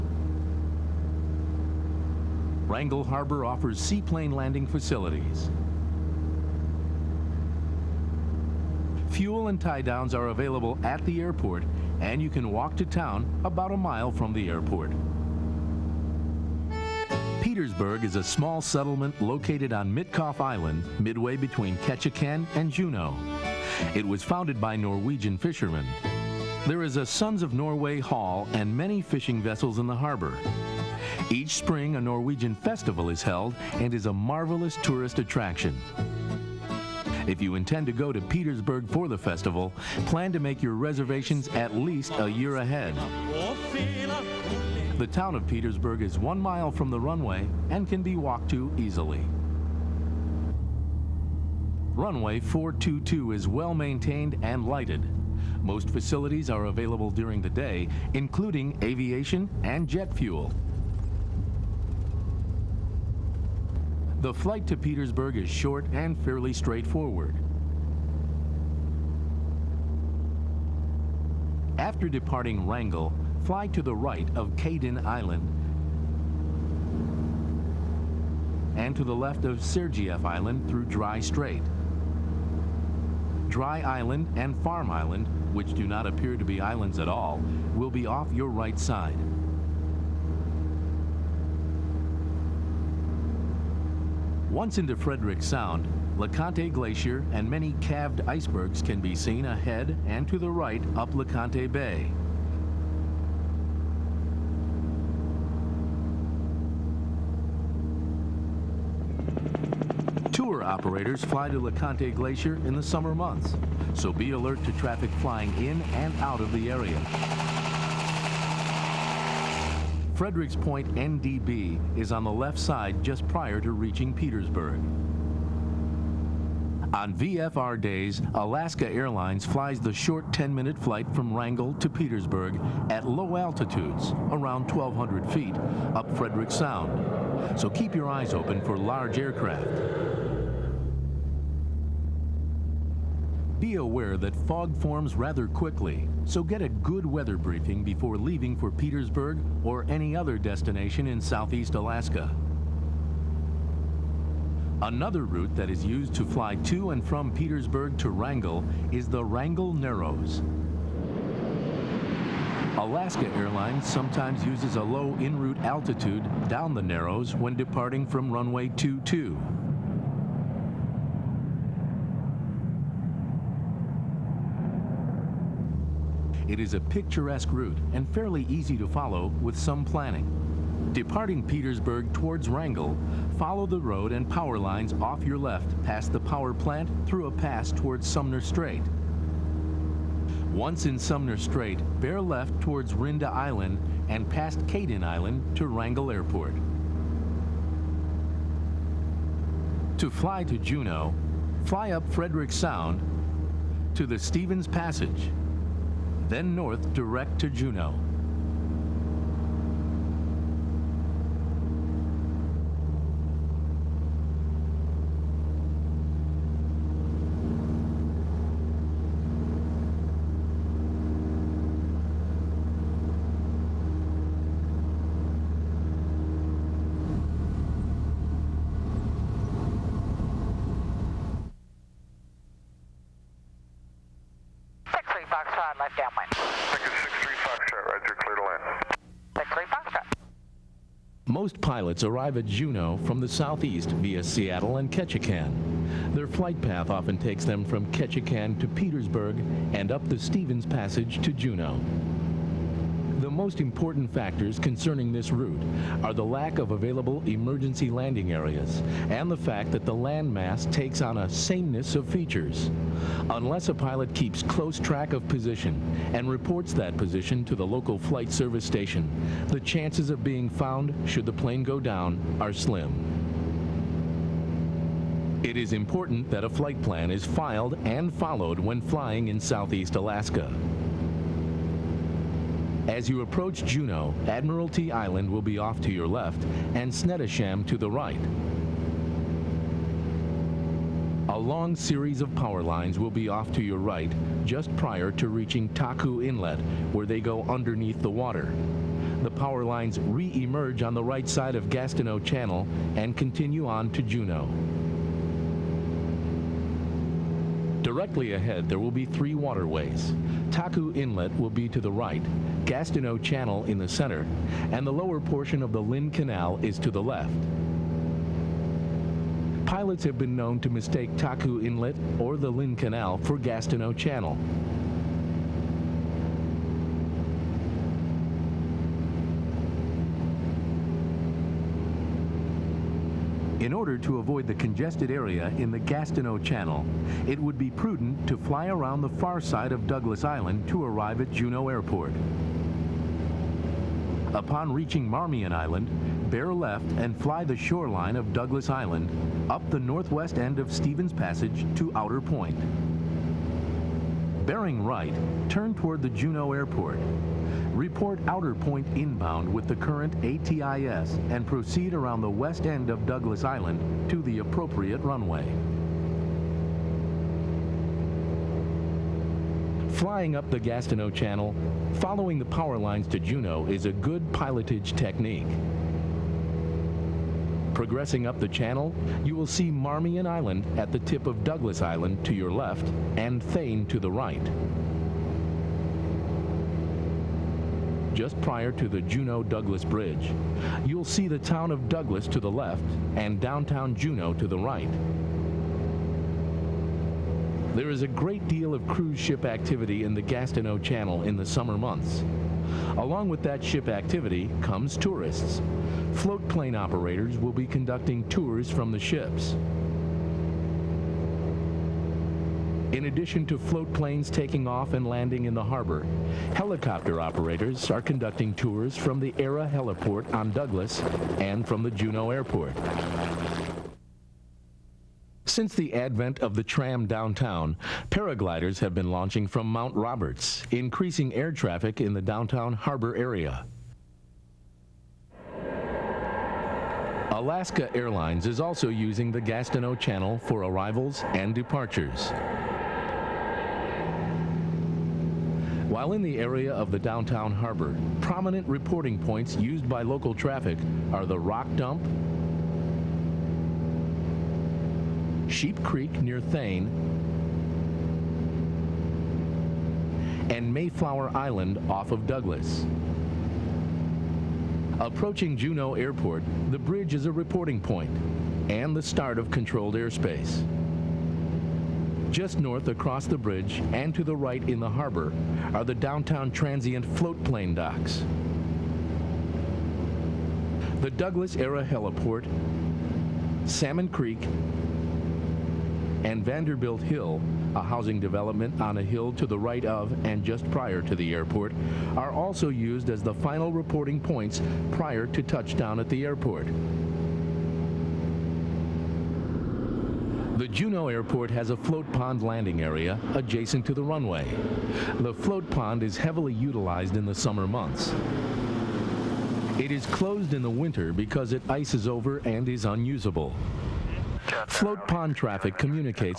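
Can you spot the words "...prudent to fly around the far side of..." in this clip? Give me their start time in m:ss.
5:37.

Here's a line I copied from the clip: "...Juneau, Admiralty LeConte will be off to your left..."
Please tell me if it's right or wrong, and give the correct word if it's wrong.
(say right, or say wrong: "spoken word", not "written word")
wrong: "Island", not "LeConte".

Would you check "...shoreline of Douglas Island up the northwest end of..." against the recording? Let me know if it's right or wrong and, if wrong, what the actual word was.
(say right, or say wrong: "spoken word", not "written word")
right.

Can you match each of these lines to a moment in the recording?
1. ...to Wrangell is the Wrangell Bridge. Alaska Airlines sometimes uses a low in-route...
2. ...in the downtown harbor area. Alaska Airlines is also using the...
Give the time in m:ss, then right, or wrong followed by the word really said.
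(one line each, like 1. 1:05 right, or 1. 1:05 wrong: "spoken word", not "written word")
1. 2:37 wrong: "Narrows", not "Bridge"
2. 7:12 right.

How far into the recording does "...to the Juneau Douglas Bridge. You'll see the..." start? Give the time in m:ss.
6:28.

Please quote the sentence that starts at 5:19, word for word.
Pilots have been known to mistake Taku Inlet or the Lynn Canal for Gastineau Channel.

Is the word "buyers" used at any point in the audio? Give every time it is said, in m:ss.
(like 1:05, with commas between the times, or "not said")
not said.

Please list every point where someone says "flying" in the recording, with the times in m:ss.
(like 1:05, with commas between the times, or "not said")
1:55, 4:38, 6:09.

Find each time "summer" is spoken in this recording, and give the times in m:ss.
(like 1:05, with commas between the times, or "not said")
1:52, 6:41, 8:27.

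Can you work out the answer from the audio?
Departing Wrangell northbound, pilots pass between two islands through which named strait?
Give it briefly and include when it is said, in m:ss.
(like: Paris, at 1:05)
Dry Strait, at 1:20.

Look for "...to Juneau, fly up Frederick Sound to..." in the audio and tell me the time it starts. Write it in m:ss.
3:20.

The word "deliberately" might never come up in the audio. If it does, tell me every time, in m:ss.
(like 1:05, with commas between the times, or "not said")
not said.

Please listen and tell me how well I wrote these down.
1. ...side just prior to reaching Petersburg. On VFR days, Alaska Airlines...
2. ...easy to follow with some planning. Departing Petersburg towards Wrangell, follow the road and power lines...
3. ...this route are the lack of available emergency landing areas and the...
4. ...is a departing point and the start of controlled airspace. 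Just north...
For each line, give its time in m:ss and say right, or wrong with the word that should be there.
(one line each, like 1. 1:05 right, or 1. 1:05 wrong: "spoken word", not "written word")
1. 2:02 right
2. 2:58 right
3. 4:15 right
4. 7:47 wrong: "reporting", not "departing".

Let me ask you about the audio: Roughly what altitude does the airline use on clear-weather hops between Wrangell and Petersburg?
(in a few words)
1,200 feet.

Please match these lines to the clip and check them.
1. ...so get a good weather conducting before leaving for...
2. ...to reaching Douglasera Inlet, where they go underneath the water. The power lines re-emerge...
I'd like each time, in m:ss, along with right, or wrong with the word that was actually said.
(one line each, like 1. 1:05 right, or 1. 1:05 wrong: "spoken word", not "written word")
1. 2:26 wrong: "briefing", not "conducting"
2. 4:55 wrong: "Taku", not "Douglasera".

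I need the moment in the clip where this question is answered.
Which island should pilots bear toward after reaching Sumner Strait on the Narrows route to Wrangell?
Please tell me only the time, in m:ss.
3:12.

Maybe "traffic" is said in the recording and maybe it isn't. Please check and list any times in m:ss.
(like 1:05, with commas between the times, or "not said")
1:54, 7:11, 7:30, 8:35.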